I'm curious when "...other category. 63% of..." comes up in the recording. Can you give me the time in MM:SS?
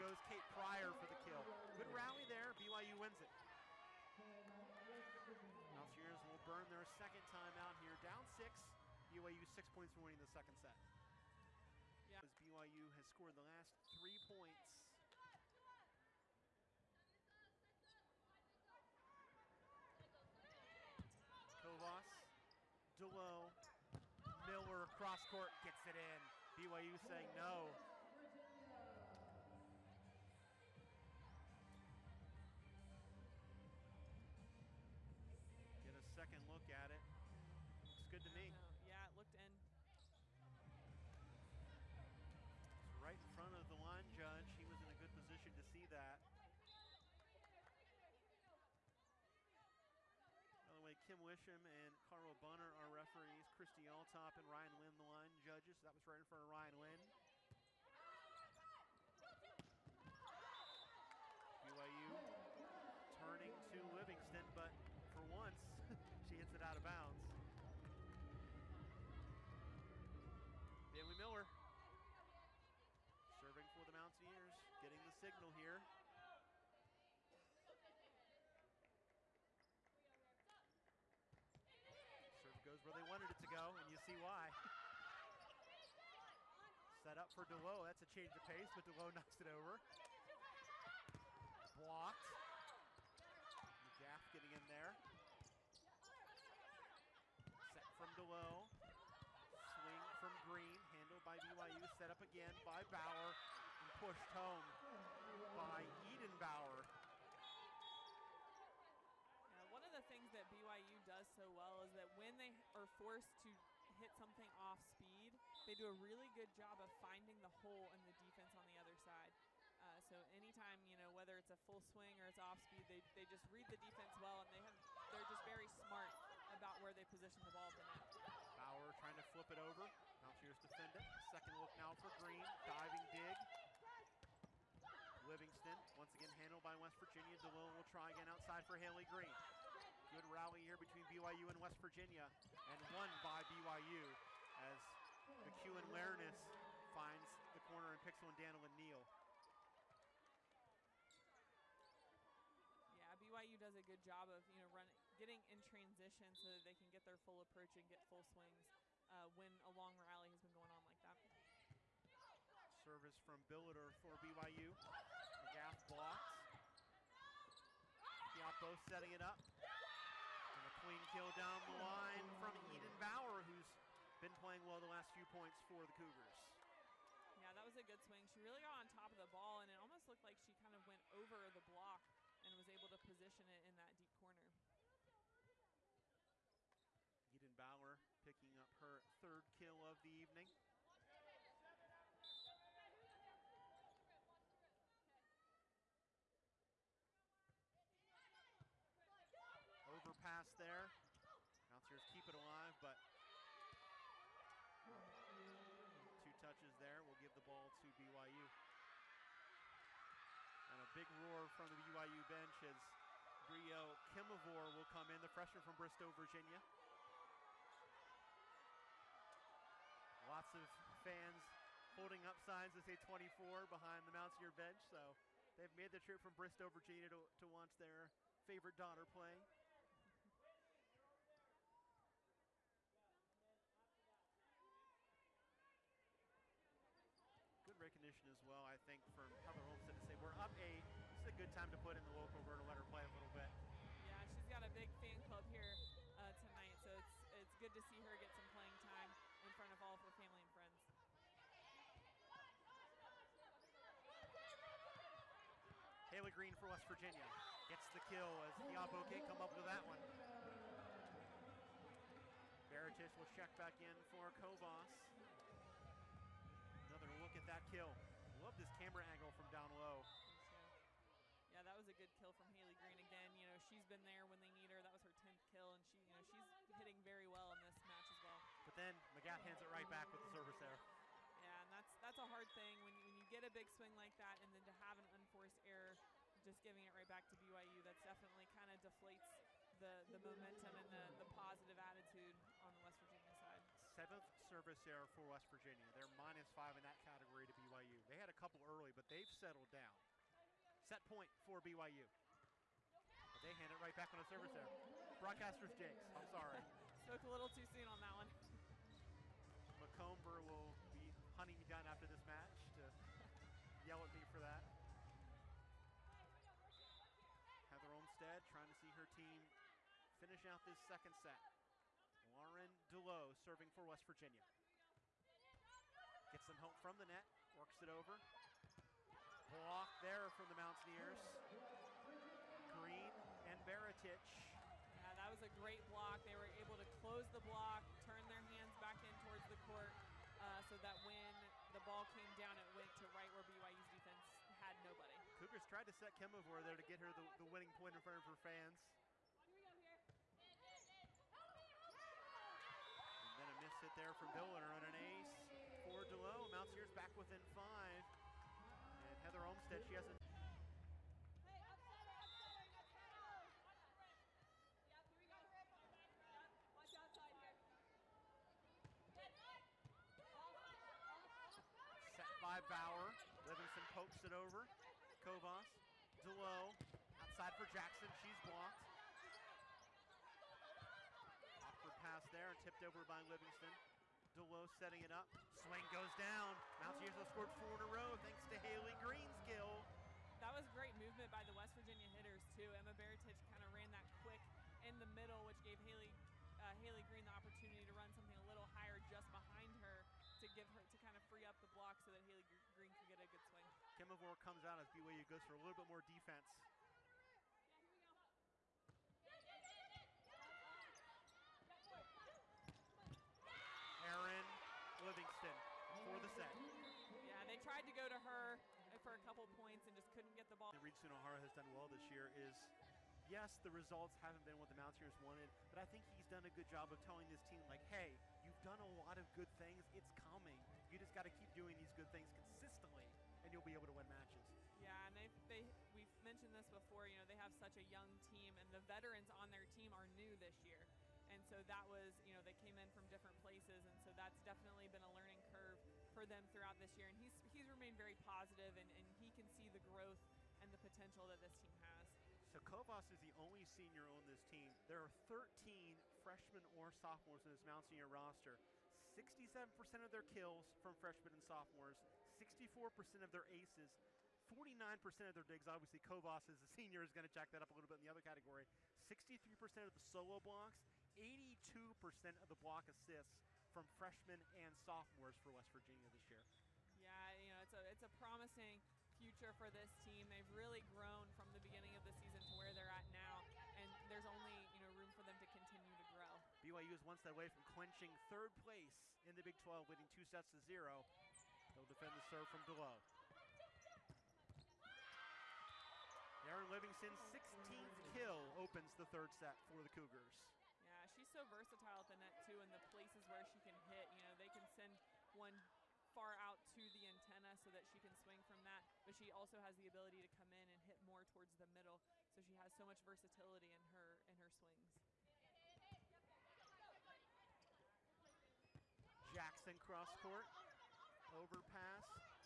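07:48.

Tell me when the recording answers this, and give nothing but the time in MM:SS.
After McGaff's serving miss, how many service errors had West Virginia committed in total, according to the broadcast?
04:53.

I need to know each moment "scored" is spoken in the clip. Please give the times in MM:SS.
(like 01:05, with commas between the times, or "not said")
00:13, 06:27.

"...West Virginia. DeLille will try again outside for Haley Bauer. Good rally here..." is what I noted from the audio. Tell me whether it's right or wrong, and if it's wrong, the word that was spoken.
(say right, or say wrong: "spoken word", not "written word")
wrong: "Green", not "Bauer".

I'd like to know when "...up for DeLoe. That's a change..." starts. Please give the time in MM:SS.
01:27.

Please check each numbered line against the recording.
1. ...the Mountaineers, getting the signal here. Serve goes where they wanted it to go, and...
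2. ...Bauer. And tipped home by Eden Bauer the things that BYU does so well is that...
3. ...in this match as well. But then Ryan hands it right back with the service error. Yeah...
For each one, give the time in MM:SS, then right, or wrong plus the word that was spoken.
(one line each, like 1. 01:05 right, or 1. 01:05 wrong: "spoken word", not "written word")
1. 01:13 right
2. 01:42 wrong: "pushed", not "tipped"
3. 04:37 wrong: "McGaff", not "Ryan".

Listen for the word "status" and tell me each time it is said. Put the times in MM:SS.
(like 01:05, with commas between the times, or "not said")
not said.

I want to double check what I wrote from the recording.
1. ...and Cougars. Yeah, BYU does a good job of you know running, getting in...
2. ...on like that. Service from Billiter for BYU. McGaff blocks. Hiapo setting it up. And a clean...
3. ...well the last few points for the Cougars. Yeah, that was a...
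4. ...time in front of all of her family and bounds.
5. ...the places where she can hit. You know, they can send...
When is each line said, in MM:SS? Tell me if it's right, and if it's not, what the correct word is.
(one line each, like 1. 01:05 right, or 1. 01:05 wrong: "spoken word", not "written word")
1. 02:28 wrong: "Neal", not "Cougars"
2. 02:40 right
3. 02:54 right
4. 04:08 wrong: "friends", not "bounds"
5. 08:22 right.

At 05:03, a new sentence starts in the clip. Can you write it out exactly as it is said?
But they hand it right back on a service error.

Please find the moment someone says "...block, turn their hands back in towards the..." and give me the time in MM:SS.
05:37.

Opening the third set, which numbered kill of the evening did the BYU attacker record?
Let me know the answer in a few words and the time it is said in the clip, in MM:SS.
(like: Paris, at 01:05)
16th, at 08:16.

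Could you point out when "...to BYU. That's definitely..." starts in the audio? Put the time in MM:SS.
04:47.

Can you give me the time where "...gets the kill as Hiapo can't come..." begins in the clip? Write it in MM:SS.
04:17.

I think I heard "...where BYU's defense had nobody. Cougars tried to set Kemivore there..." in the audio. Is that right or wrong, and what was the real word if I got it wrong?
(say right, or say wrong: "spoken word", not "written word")
right.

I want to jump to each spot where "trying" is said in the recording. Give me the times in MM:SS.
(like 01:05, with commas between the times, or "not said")
02:09, 05:18.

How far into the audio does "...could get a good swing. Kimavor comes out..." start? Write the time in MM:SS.
06:42.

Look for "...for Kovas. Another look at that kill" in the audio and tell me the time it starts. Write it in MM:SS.
04:24.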